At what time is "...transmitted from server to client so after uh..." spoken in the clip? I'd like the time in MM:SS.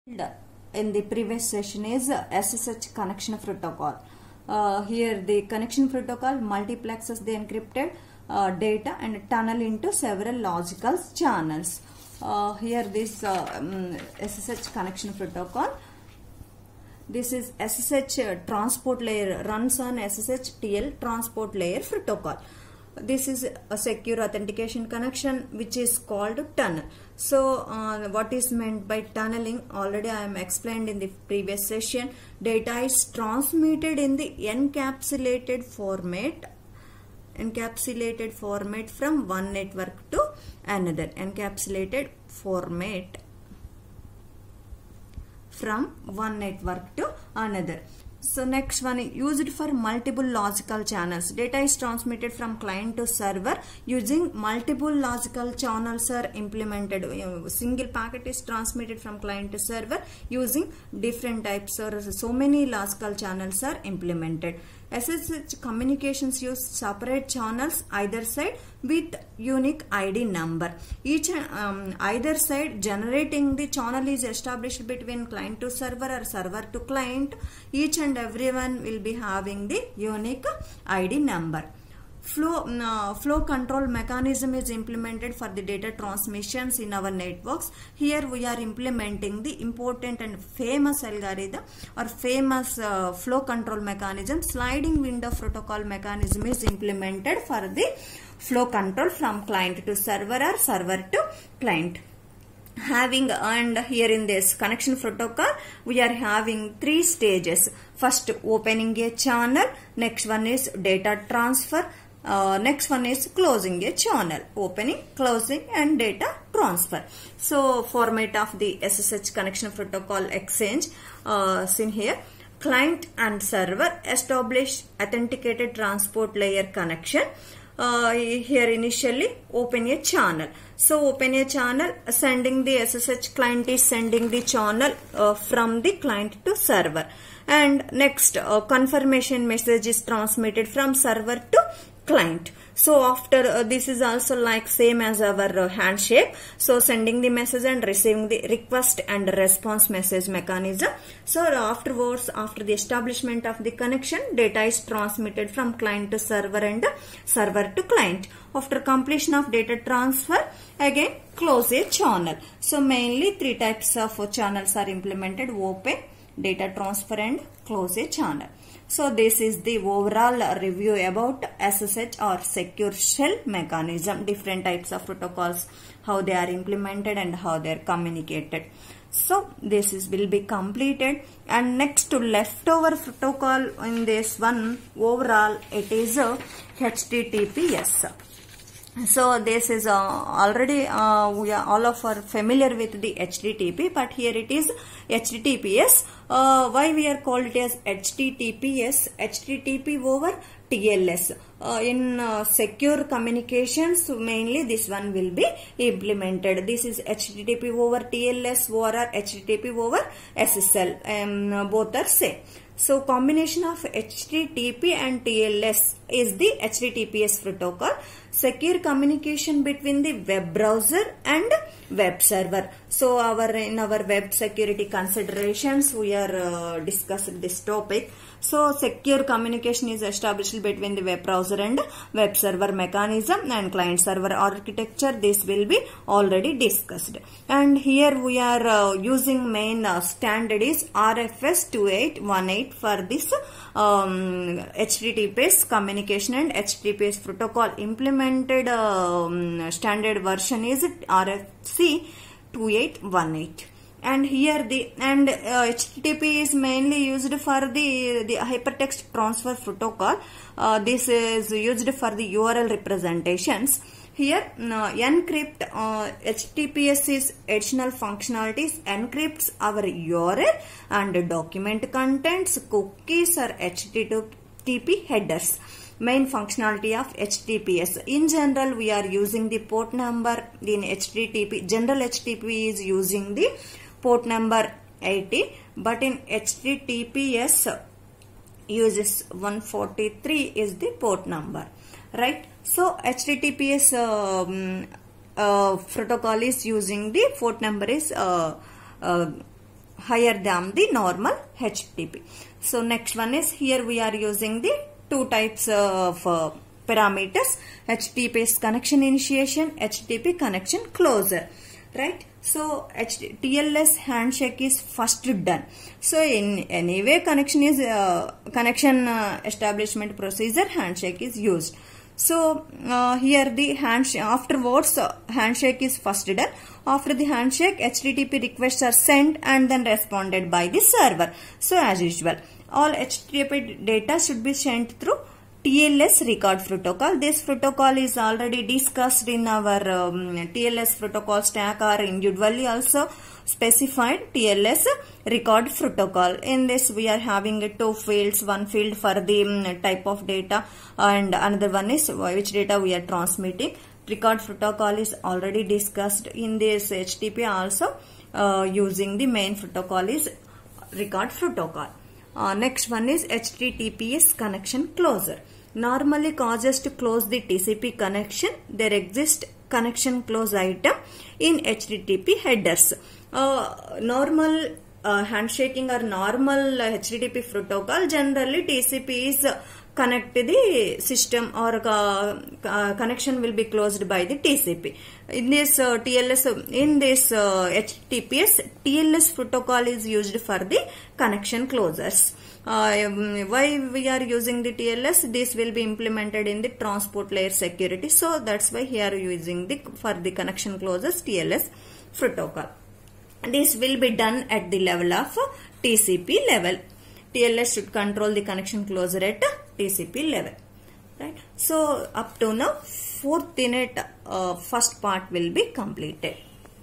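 02:20.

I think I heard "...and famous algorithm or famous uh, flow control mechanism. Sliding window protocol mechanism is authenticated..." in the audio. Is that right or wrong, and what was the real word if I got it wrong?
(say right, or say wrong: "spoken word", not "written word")
wrong: "implemented", not "authenticated".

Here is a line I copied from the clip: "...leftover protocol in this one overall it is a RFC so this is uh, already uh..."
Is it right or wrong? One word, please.
wrong.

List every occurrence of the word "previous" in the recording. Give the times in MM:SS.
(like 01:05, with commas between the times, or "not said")
00:01, 00:31.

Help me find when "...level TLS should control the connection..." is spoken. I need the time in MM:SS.
06:46.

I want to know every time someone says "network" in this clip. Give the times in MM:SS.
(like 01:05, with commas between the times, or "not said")
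00:39, 00:46, 01:27.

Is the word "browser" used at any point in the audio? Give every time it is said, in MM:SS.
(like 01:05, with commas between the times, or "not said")
03:40, 03:51.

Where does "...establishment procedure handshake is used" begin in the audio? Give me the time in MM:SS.
05:19.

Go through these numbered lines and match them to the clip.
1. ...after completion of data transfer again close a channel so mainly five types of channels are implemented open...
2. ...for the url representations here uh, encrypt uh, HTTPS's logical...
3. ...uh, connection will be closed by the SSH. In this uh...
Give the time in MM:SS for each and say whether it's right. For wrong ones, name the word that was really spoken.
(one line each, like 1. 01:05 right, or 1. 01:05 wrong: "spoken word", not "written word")
1. 02:38 wrong: "three", not "five"
2. 04:21 wrong: "additional", not "logical"
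3. 06:21 wrong: "TCP", not "SSH".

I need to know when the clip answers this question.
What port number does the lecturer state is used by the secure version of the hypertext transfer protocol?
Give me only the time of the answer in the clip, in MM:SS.
04:49.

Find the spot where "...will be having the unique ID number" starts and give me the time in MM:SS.
01:18.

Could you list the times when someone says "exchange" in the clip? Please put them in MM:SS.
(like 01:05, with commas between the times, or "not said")
02:00.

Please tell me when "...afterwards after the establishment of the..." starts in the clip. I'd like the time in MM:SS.
02:31.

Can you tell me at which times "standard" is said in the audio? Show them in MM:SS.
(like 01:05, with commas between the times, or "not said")
03:59, 04:09.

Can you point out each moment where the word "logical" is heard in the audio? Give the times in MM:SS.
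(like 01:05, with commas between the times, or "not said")
00:10, 00:50, 00:54, 01:02.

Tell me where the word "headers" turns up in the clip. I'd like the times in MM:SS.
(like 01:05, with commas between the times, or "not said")
04:35, 06:12.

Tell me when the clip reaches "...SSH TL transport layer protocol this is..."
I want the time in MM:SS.
00:19.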